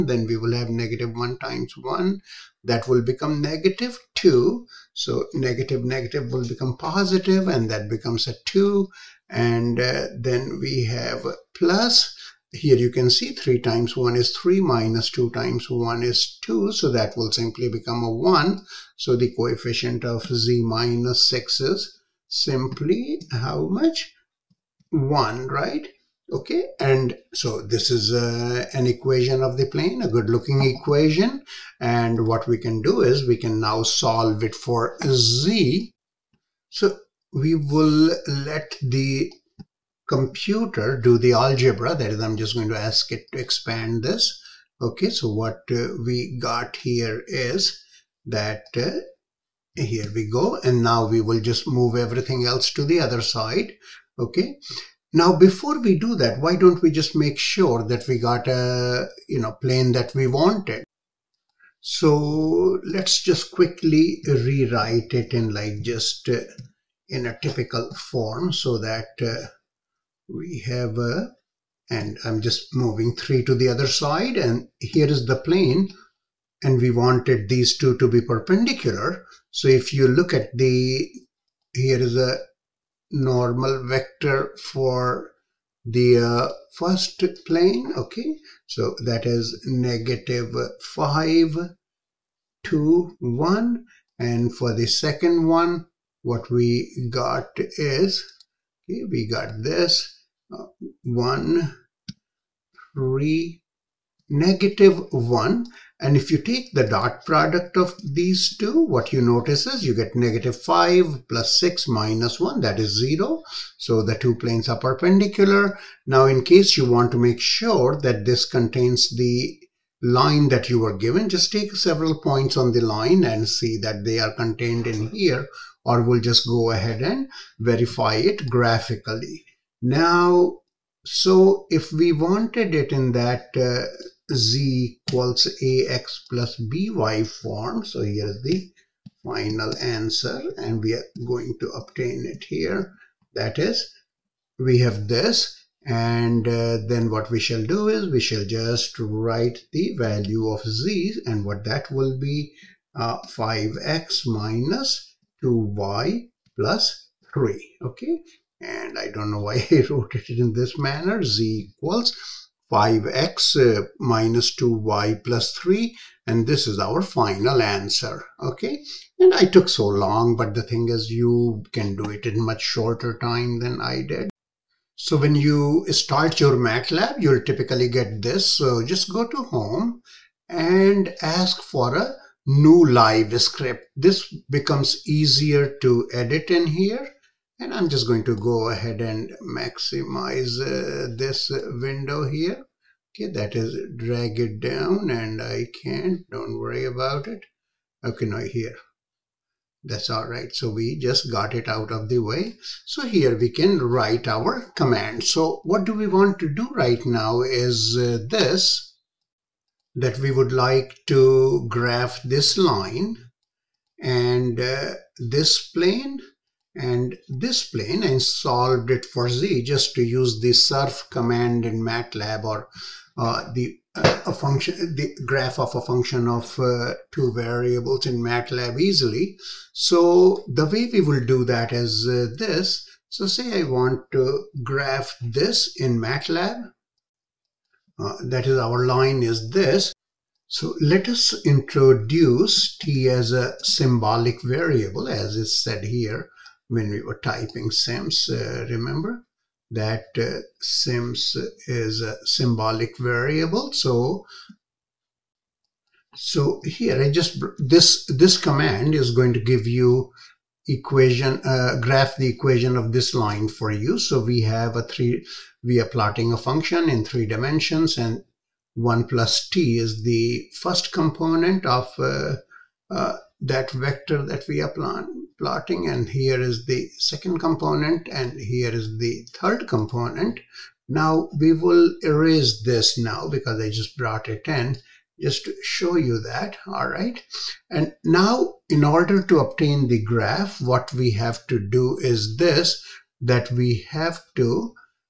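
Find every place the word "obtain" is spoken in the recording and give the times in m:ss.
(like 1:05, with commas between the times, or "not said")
2:21, 4:49.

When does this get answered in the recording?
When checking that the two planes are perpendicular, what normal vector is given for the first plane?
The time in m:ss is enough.
1:30.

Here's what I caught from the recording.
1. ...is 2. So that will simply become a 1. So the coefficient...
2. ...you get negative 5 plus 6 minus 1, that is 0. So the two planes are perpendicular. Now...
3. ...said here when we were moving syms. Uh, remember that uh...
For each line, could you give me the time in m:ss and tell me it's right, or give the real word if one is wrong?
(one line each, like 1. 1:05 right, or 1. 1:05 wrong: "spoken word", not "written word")
1. 0:16 right
2. 1:49 right
3. 4:05 wrong: "typing", not "moving".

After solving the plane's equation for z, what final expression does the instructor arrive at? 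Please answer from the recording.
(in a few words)
z = 5x - 2y + 3.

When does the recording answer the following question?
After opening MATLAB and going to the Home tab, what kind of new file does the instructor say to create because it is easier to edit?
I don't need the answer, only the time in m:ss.
3:02.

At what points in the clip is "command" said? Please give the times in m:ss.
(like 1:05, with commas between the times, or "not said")
3:24, 3:41, 4:18.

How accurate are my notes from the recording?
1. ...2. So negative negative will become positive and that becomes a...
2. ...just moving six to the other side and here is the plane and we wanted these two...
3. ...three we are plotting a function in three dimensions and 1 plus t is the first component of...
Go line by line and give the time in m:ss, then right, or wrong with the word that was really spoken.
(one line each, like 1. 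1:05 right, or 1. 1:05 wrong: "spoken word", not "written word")
1. 0:04 right
2. 1:12 wrong: "three", not "six"
3. 4:24 right.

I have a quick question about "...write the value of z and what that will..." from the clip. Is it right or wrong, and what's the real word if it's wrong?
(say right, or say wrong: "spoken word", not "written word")
right.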